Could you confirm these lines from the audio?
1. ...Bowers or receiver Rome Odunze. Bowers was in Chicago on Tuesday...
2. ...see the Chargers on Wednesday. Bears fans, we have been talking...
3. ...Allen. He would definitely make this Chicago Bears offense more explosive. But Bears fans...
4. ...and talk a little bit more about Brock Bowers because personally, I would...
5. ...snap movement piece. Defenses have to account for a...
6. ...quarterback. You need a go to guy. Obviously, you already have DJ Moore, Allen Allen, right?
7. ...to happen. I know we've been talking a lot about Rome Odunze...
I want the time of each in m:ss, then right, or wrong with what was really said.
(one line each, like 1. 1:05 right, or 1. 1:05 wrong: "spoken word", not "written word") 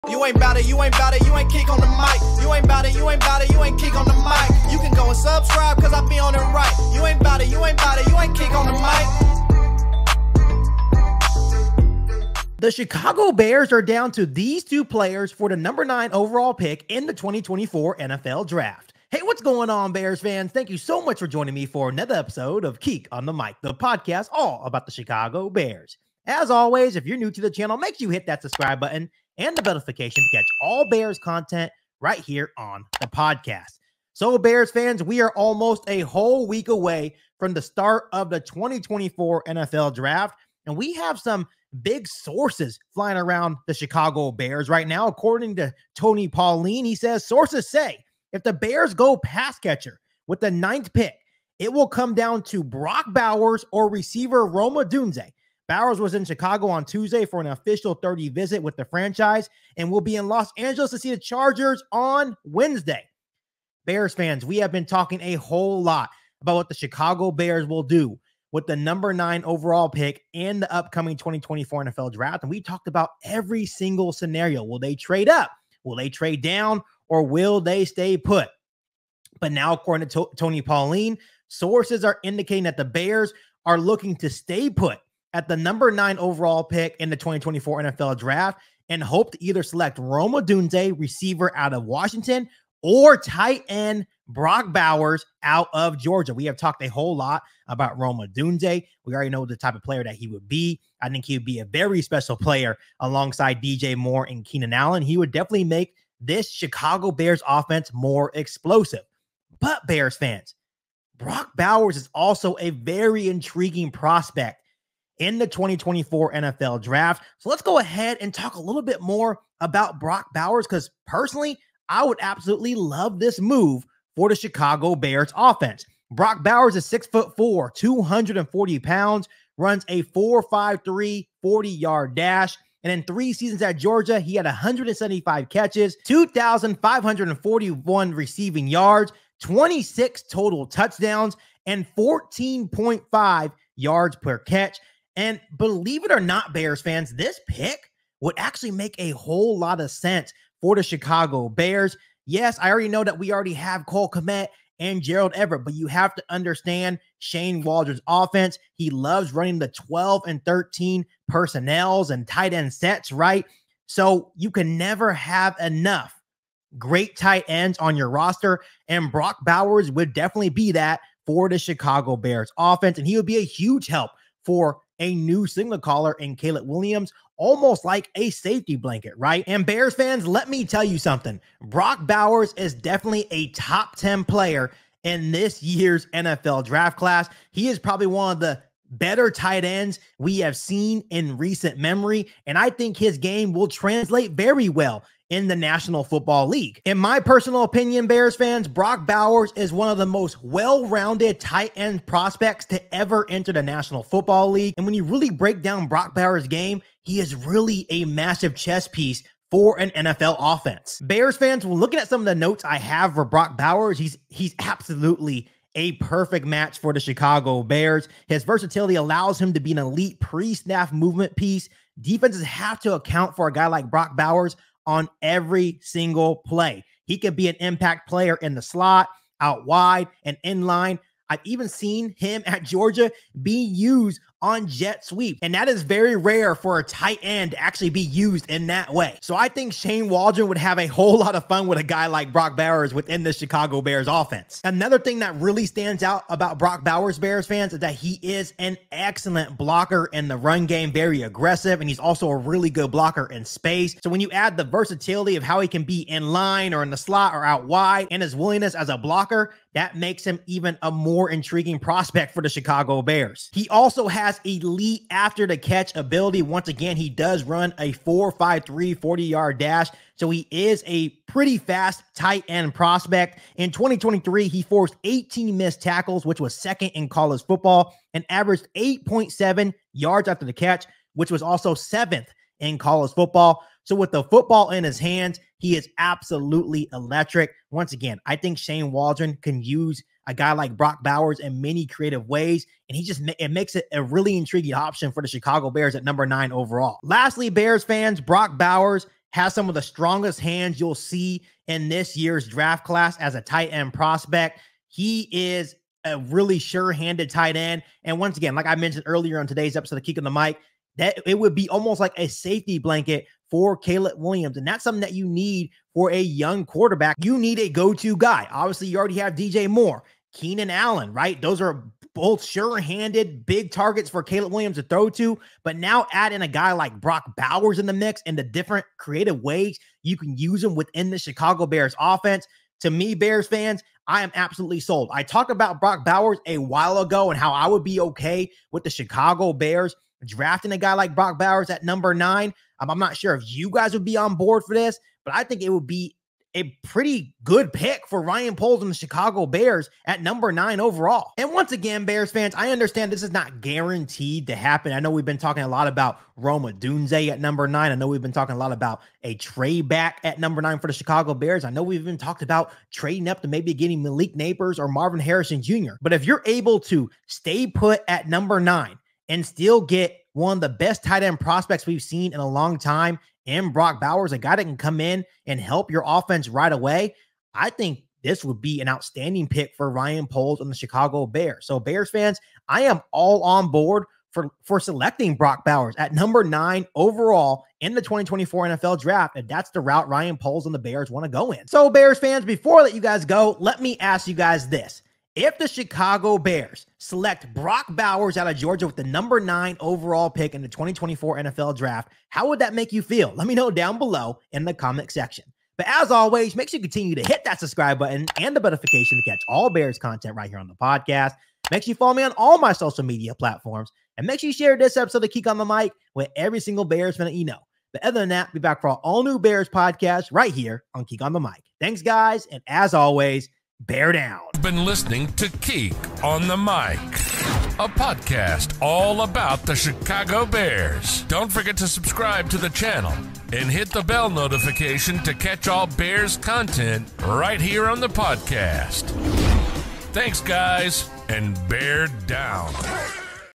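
1. 0:53 right
2. 1:00 right
3. 1:44 right
4. 1:58 right
5. 3:40 right
6. 5:16 wrong: "Keenan", not "Allen"
7. 5:54 right.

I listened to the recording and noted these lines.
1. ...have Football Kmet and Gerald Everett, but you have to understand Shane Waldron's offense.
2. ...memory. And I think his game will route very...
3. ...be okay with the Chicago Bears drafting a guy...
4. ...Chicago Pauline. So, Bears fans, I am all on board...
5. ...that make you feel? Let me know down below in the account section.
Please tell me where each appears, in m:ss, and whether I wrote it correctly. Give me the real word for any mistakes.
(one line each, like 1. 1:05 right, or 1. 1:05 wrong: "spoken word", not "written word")
1. 2:33 wrong: "Cole", not "Football"
2. 3:11 wrong: "translate", not "route"
3. 5:37 right
4. 6:20 wrong: "Bears", not "Pauline"
5. 6:42 wrong: "comment", not "account".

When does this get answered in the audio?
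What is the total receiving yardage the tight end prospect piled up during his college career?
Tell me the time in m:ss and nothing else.
2:16.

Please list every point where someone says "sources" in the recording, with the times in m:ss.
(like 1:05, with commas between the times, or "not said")
0:42, 0:47, 1:21.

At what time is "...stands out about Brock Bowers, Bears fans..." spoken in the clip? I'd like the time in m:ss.
4:05.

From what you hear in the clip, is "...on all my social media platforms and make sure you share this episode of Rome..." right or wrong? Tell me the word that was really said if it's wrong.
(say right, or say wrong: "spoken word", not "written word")
wrong: "Kieq", not "Rome".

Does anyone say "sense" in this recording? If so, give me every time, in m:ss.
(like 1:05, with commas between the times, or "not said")
2:29.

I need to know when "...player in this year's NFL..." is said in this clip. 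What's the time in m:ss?
3:04.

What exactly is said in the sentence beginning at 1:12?
And we talked about every single scenario.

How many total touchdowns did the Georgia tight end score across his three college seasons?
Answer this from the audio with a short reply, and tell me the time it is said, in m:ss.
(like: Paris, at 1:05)
26, at 2:19.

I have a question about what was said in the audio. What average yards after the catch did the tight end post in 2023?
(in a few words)
8.7.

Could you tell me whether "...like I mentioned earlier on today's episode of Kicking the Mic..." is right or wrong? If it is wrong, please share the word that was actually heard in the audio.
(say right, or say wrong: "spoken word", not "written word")
right.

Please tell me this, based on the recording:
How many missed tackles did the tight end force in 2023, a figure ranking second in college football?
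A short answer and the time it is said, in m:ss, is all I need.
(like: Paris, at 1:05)
18, at 4:35.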